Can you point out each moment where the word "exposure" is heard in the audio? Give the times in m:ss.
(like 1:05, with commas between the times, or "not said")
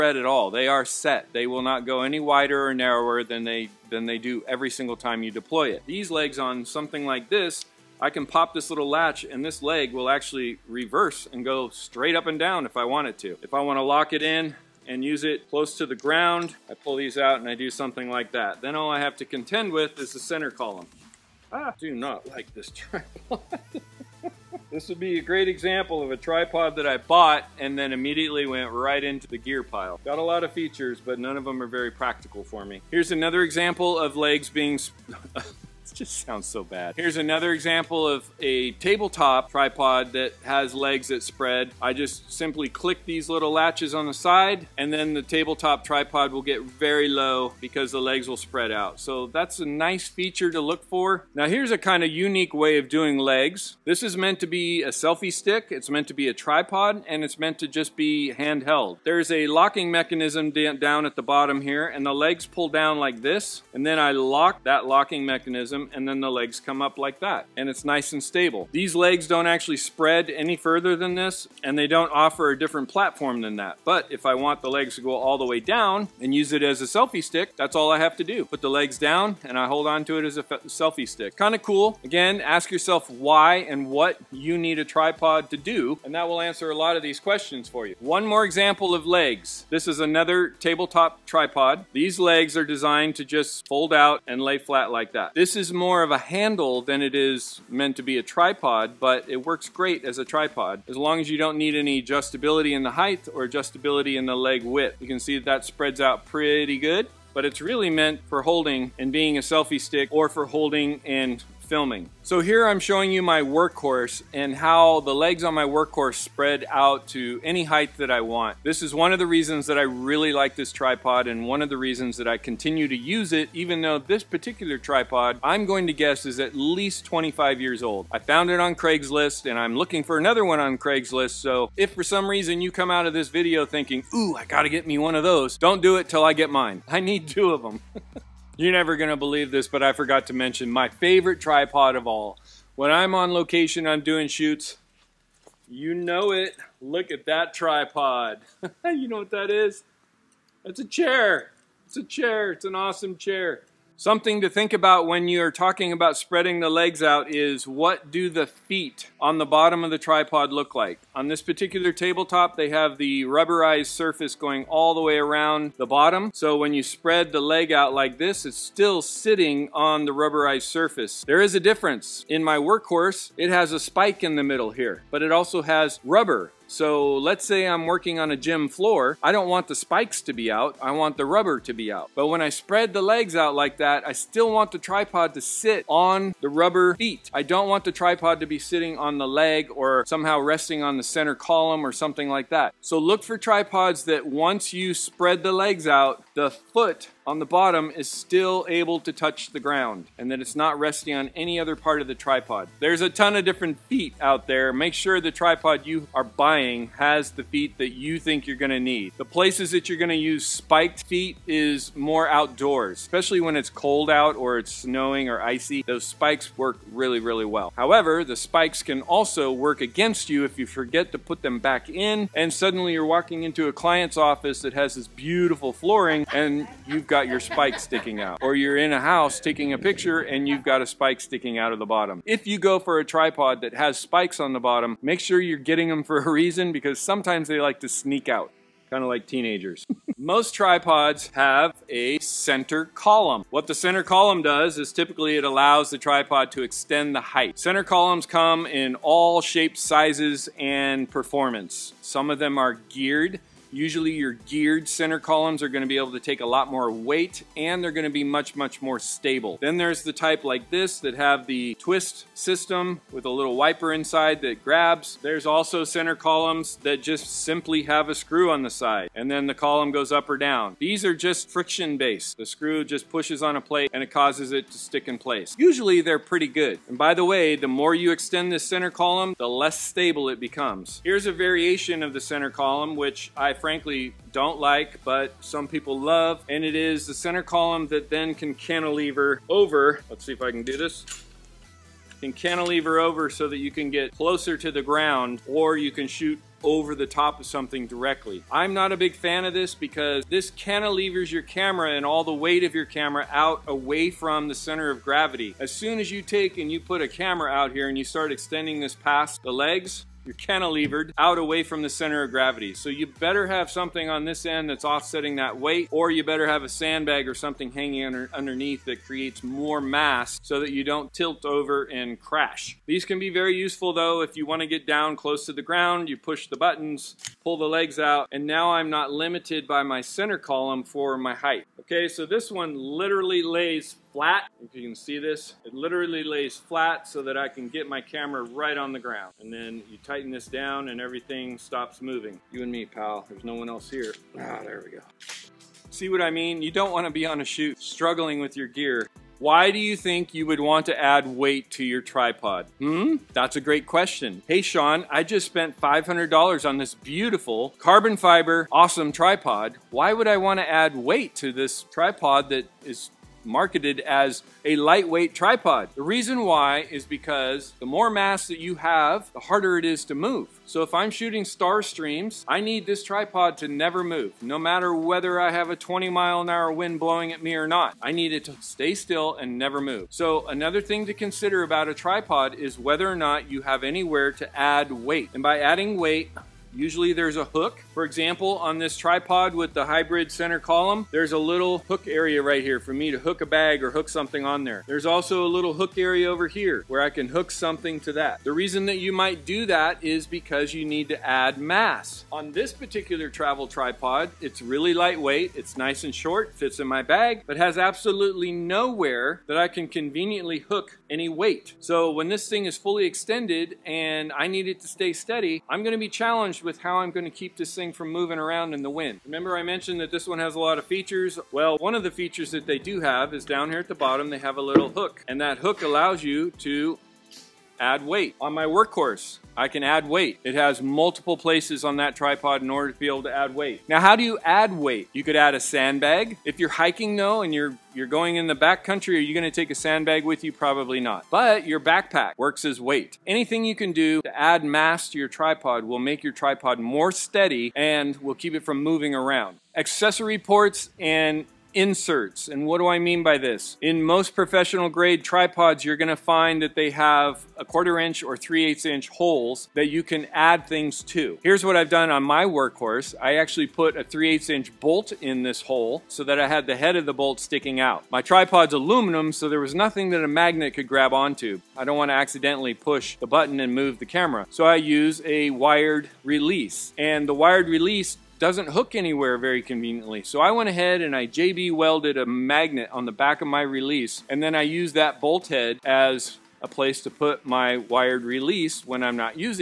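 not said.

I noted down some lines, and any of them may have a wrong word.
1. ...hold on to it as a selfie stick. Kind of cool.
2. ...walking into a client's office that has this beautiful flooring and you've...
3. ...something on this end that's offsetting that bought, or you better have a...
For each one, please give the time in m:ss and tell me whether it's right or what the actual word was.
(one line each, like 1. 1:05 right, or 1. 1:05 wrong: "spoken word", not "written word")
1. 1:19 right
2. 3:43 right
3. 5:13 wrong: "weight", not "bought".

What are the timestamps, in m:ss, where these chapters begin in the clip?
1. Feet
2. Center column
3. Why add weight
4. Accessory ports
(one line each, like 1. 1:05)
1. 2:32
2. 3:58
3. 5:47
4. 7:27.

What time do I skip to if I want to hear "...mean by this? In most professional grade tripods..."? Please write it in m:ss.
7:32.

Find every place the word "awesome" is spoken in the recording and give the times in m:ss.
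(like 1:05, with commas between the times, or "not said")
2:32, 5:58.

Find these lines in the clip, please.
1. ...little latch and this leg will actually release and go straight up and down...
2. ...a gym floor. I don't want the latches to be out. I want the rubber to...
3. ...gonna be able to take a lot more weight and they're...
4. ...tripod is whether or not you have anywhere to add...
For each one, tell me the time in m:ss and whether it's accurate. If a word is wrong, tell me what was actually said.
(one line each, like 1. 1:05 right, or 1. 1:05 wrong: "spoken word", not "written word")
1. 0:08 wrong: "reverse", not "release"
2. 2:58 wrong: "spikes", not "latches"
3. 4:15 right
4. 6:21 right.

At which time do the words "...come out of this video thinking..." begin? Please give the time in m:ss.
2:12.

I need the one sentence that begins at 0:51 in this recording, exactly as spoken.
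Now here's a kind of unique way of doing legs.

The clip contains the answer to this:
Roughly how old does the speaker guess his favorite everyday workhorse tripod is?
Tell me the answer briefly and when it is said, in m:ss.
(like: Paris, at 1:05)
25 years, at 2:07.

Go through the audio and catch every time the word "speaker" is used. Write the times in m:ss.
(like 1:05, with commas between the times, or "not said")
not said.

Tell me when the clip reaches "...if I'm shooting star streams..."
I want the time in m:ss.
6:10.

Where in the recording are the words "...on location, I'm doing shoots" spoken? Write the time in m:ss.
2:23.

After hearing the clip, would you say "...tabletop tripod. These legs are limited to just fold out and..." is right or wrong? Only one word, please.
wrong.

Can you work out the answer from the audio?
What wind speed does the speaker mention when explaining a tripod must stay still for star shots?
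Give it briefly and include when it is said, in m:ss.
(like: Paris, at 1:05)
20 miles per hour, at 6:15.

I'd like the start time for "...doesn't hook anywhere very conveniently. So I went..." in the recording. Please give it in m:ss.
7:58.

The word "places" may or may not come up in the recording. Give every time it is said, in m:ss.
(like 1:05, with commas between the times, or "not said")
3:29, 4:35, 7:11, 8:06.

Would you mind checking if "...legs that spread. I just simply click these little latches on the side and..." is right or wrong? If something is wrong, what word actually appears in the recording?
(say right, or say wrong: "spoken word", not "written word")
right.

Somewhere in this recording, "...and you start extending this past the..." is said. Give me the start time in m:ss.
5:07.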